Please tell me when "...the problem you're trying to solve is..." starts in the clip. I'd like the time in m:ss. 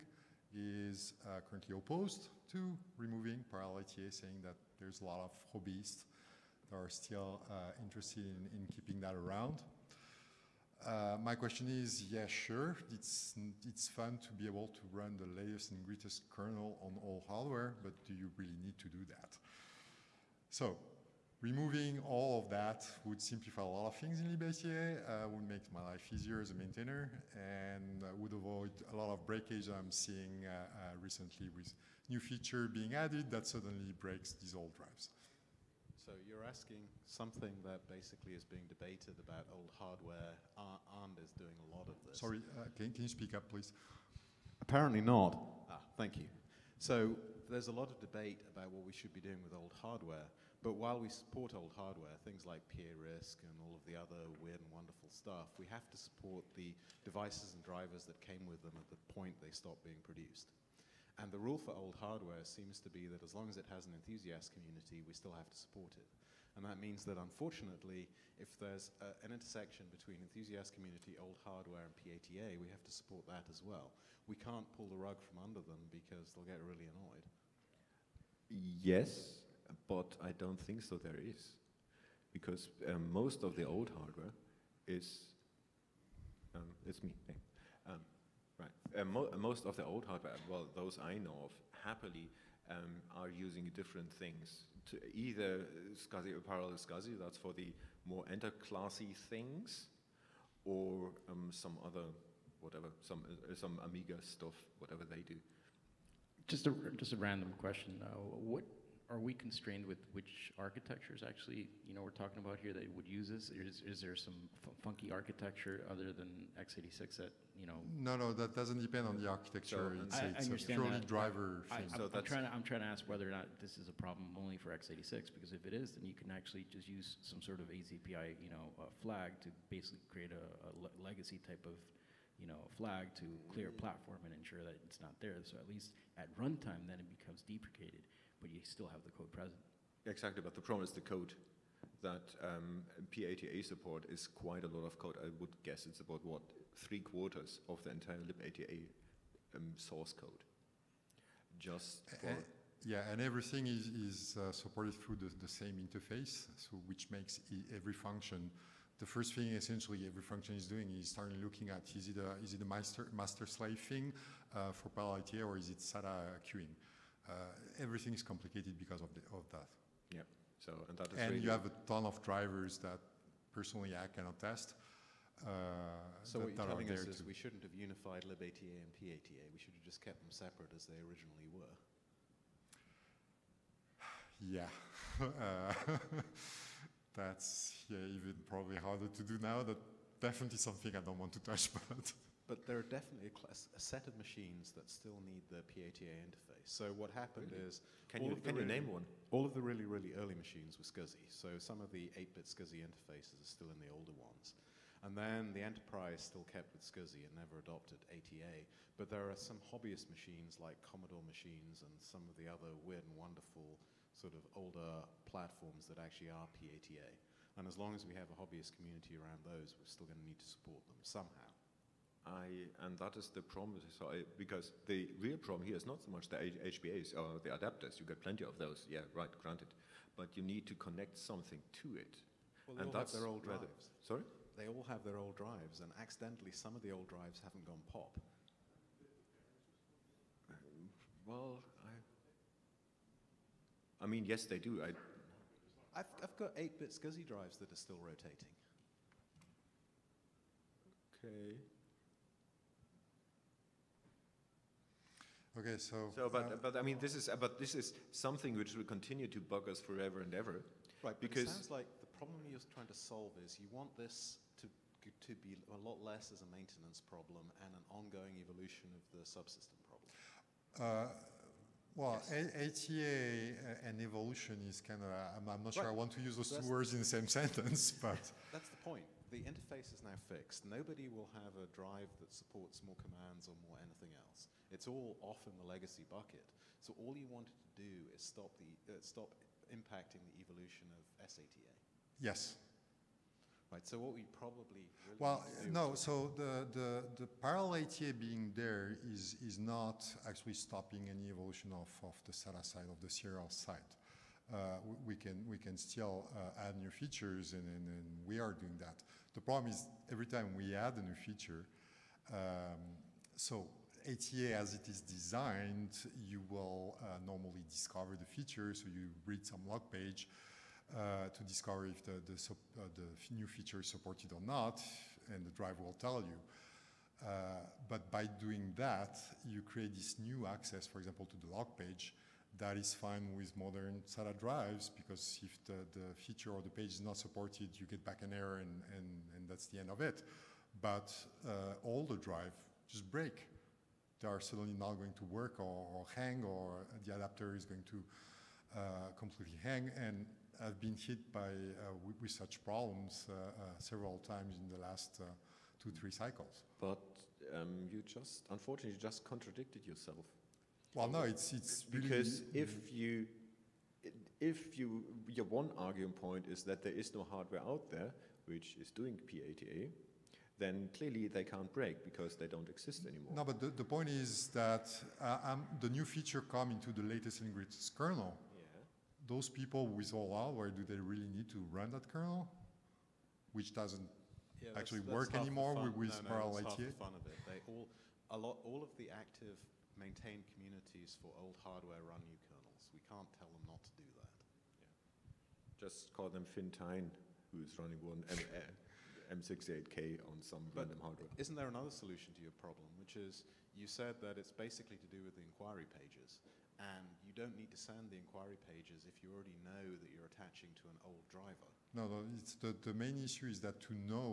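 4:21.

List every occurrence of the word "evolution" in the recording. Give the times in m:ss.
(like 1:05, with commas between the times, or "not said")
4:28, 4:33, 4:50, 5:01.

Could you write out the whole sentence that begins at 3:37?
And as long as we have a hobbyist community around those, we're still going to need to support them somehow.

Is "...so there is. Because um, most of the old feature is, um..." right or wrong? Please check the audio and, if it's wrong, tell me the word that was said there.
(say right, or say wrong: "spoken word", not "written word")
wrong: "hardware", not "feature".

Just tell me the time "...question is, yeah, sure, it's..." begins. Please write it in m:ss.
0:11.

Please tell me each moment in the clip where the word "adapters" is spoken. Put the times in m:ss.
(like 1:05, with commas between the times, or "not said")
3:47, 5:47.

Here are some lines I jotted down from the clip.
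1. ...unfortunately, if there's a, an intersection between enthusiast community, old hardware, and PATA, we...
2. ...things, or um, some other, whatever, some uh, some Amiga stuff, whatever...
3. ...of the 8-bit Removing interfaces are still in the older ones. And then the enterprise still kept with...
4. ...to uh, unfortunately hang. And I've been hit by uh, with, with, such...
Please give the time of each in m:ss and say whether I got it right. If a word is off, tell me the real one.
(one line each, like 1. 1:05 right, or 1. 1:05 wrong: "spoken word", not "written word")
1. 1:07 right
2. 1:39 right
3. 3:21 wrong: "SCSI", not "Removing"
4. 5:47 wrong: "completely", not "unfortunately".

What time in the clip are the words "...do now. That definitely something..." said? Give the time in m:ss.
3:09.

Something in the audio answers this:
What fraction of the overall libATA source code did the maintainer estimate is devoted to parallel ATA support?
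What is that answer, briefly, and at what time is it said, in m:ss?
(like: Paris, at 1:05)
three quarters, at 2:26.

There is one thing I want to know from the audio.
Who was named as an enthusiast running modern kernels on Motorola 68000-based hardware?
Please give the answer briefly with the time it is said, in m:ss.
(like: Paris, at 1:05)
Finn Thain, at 6:36.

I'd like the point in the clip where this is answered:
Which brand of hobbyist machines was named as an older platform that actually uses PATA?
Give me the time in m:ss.
3:30.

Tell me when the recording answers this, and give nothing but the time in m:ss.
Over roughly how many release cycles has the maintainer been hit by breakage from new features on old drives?
5:55.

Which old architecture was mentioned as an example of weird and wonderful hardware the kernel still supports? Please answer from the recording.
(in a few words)
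PA-RISC.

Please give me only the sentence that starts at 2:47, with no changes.
Uh, everything is complicated because of, the, of that.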